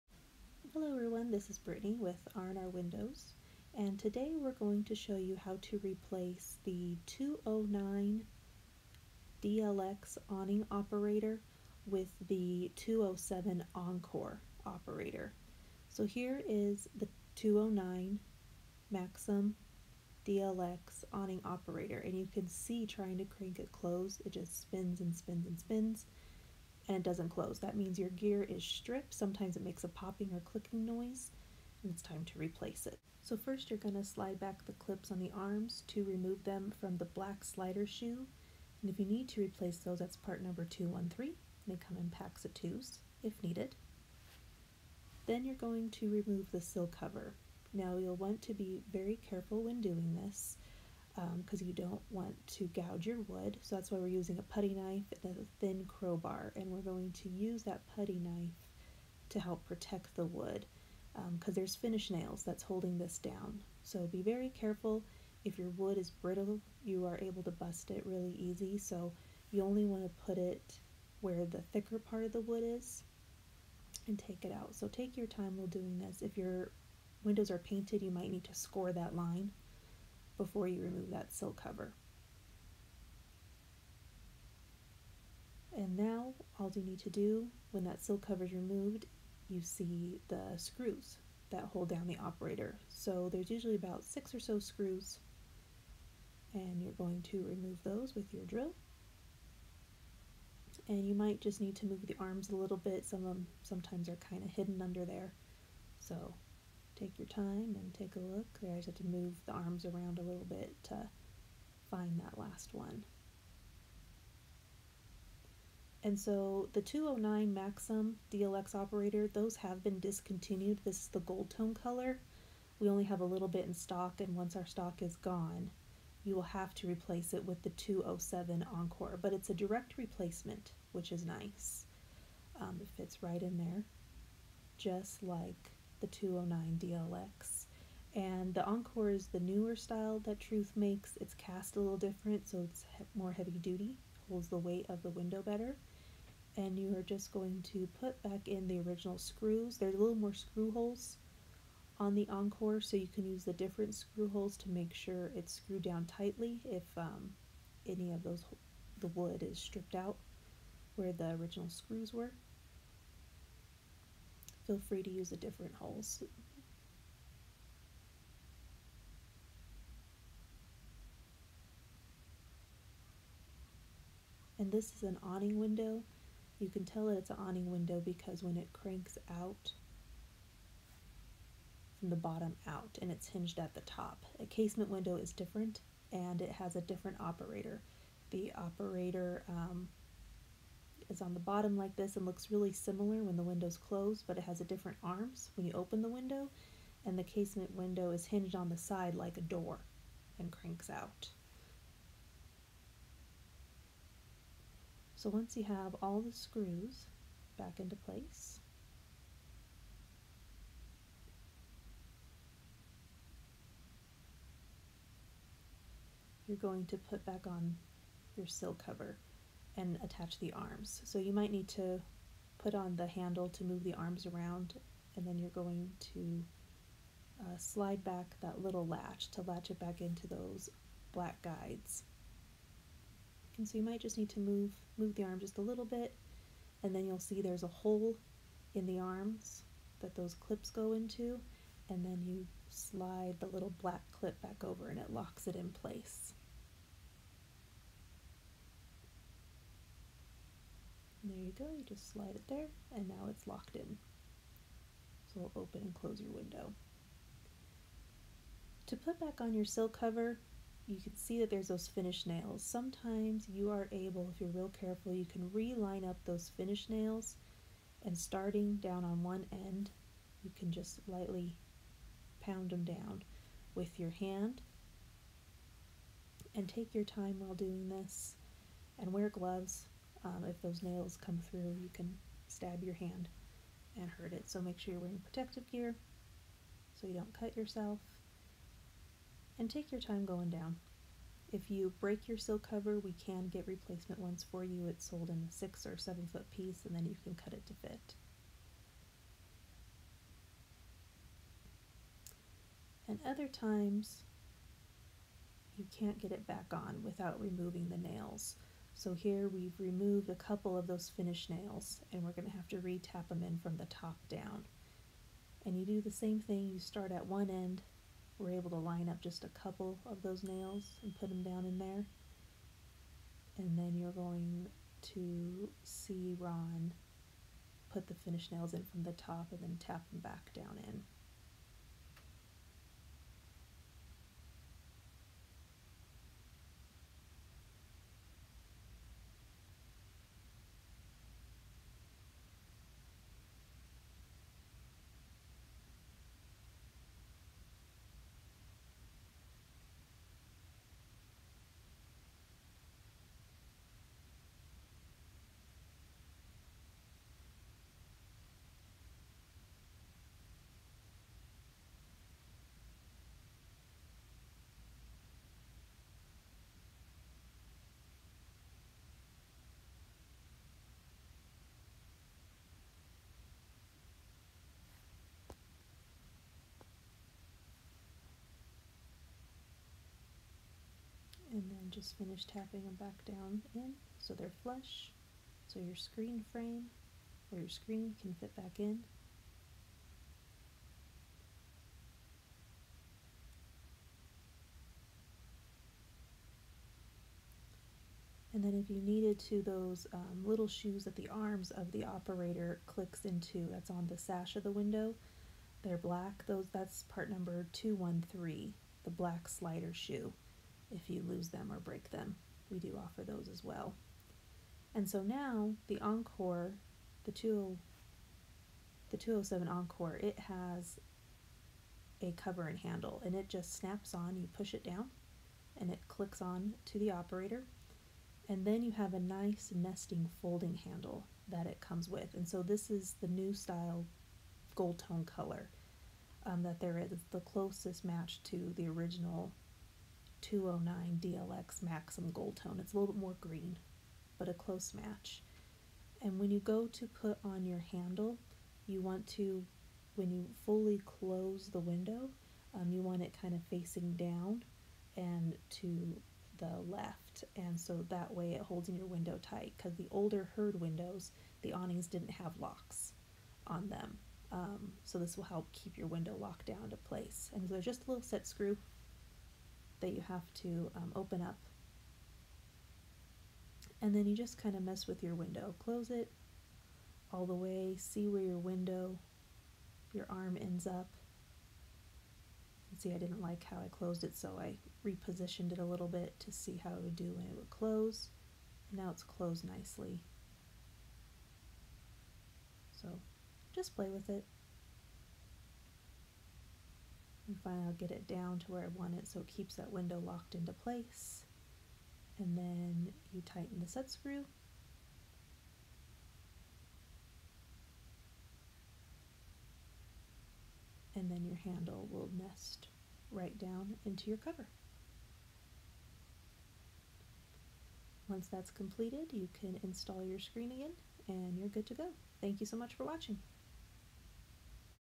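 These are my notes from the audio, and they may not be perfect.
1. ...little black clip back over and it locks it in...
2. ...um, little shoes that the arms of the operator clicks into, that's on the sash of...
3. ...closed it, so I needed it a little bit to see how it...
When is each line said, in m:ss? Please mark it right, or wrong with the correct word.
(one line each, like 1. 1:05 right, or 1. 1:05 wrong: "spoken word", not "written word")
1. 4:03 right
2. 6:40 right
3. 8:03 wrong: "repositioned", not "needed".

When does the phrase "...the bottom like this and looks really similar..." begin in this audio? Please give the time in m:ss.
3:11.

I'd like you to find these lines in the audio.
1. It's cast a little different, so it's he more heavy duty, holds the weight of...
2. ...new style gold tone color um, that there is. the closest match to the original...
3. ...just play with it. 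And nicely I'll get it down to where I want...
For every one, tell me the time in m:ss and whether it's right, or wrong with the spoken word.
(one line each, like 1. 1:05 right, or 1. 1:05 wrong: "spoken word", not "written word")
1. 2:21 right
2. 7:13 right
3. 8:13 wrong: "finally", not "nicely".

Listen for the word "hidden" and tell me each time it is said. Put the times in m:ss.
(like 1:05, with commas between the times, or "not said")
1:44.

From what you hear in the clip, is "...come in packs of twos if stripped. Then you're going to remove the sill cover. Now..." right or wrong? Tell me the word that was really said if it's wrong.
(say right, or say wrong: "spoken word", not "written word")
wrong: "needed", not "stripped".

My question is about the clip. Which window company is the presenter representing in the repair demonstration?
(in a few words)
R&R Windows.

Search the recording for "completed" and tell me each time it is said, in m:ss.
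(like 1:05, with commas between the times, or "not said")
8:38.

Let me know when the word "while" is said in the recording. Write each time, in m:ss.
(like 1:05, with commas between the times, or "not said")
1:15, 4:37.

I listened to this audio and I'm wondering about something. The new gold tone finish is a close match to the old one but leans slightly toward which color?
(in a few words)
green.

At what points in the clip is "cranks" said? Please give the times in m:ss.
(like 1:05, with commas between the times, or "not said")
0:23, 2:58, 3:20.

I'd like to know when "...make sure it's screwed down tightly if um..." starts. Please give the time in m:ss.
2:34.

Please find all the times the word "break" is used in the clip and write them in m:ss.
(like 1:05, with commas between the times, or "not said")
4:51, 6:51.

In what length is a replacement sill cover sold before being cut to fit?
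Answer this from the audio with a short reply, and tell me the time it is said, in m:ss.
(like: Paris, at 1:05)
6 or 7 foot, at 4:55.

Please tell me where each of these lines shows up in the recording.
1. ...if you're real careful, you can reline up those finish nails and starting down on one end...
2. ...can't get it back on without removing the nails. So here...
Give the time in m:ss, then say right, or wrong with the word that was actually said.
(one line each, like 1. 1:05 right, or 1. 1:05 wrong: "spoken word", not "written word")
1. 4:24 right
2. 5:05 right.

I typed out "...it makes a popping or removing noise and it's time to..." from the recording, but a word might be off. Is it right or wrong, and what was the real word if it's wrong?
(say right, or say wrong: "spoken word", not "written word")
wrong: "clicking", not "removing".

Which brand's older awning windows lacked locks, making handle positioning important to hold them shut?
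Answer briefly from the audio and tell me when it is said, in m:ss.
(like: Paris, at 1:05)
Hurd, at 7:40.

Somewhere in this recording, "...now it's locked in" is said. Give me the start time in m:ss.
4:13.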